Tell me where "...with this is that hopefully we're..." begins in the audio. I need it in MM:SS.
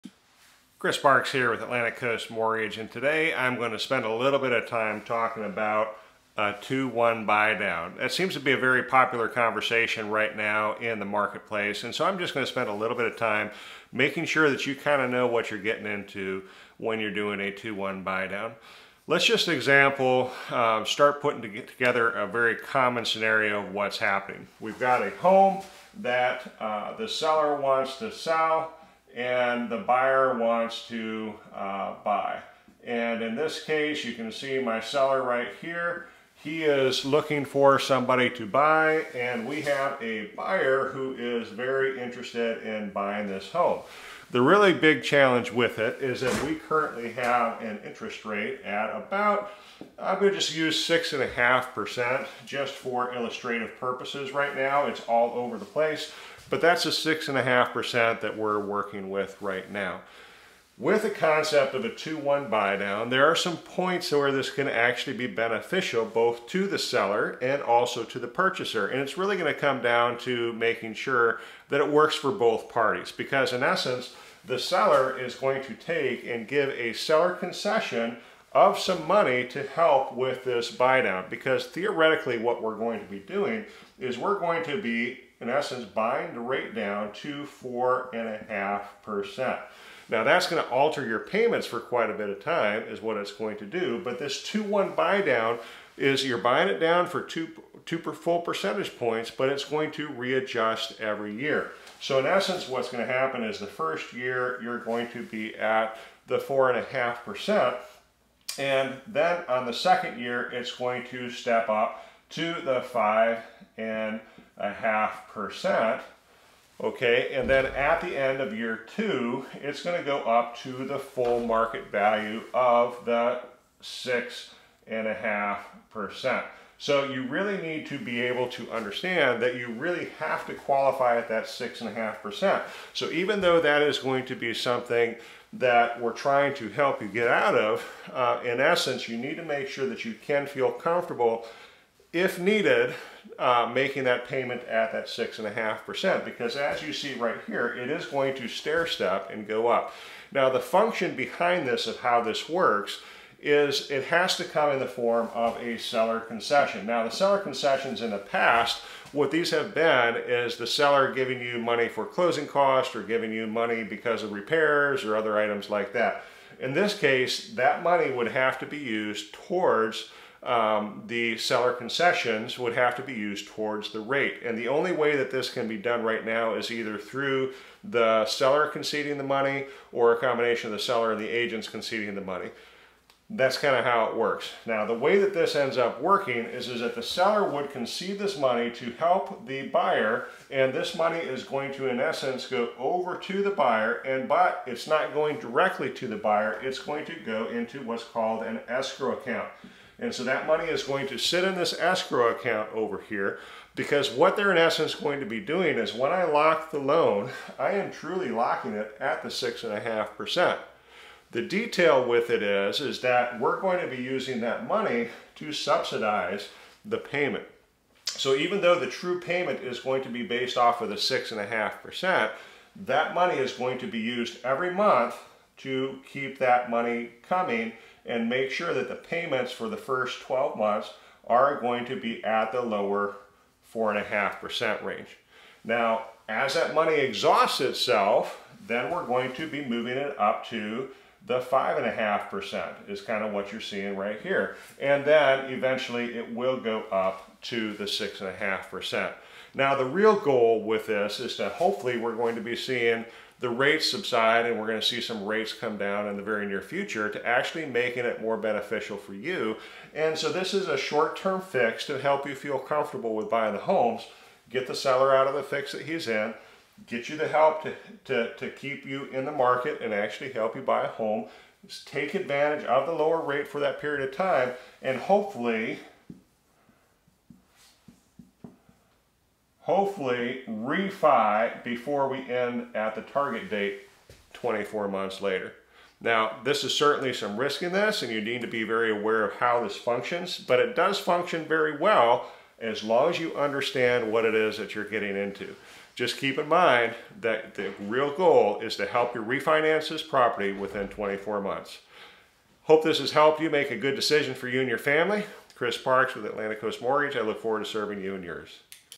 04:10.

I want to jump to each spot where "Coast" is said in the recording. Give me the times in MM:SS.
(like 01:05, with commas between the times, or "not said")
00:01, 05:06.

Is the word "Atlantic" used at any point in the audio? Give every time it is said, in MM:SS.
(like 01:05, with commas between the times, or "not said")
00:01, 05:06.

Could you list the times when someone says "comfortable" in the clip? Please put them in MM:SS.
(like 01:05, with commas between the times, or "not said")
02:20, 04:22.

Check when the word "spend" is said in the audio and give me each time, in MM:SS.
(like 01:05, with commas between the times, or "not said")
00:03, 00:12.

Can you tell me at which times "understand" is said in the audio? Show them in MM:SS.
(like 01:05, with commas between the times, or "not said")
02:08, 04:53.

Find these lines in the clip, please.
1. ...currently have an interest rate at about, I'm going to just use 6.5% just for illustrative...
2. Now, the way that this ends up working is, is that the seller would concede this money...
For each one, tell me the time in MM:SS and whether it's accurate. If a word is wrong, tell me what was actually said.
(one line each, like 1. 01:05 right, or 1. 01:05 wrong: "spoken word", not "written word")
1. 00:46 right
2. 03:04 right.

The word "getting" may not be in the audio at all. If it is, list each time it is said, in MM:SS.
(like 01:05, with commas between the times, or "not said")
00:15, 04:54.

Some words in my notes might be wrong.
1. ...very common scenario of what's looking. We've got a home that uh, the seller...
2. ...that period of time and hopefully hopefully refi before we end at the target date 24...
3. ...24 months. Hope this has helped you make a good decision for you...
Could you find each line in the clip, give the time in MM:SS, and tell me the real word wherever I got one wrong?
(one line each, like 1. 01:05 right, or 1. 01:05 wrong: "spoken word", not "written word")
1. 00:22 wrong: "happening", not "looking"
2. 04:33 right
3. 05:00 right.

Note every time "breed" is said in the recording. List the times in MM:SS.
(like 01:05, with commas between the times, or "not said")
not said.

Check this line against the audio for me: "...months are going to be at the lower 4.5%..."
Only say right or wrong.
right.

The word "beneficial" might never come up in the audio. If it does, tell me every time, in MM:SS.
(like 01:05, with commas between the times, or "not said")
01:05, 04:18.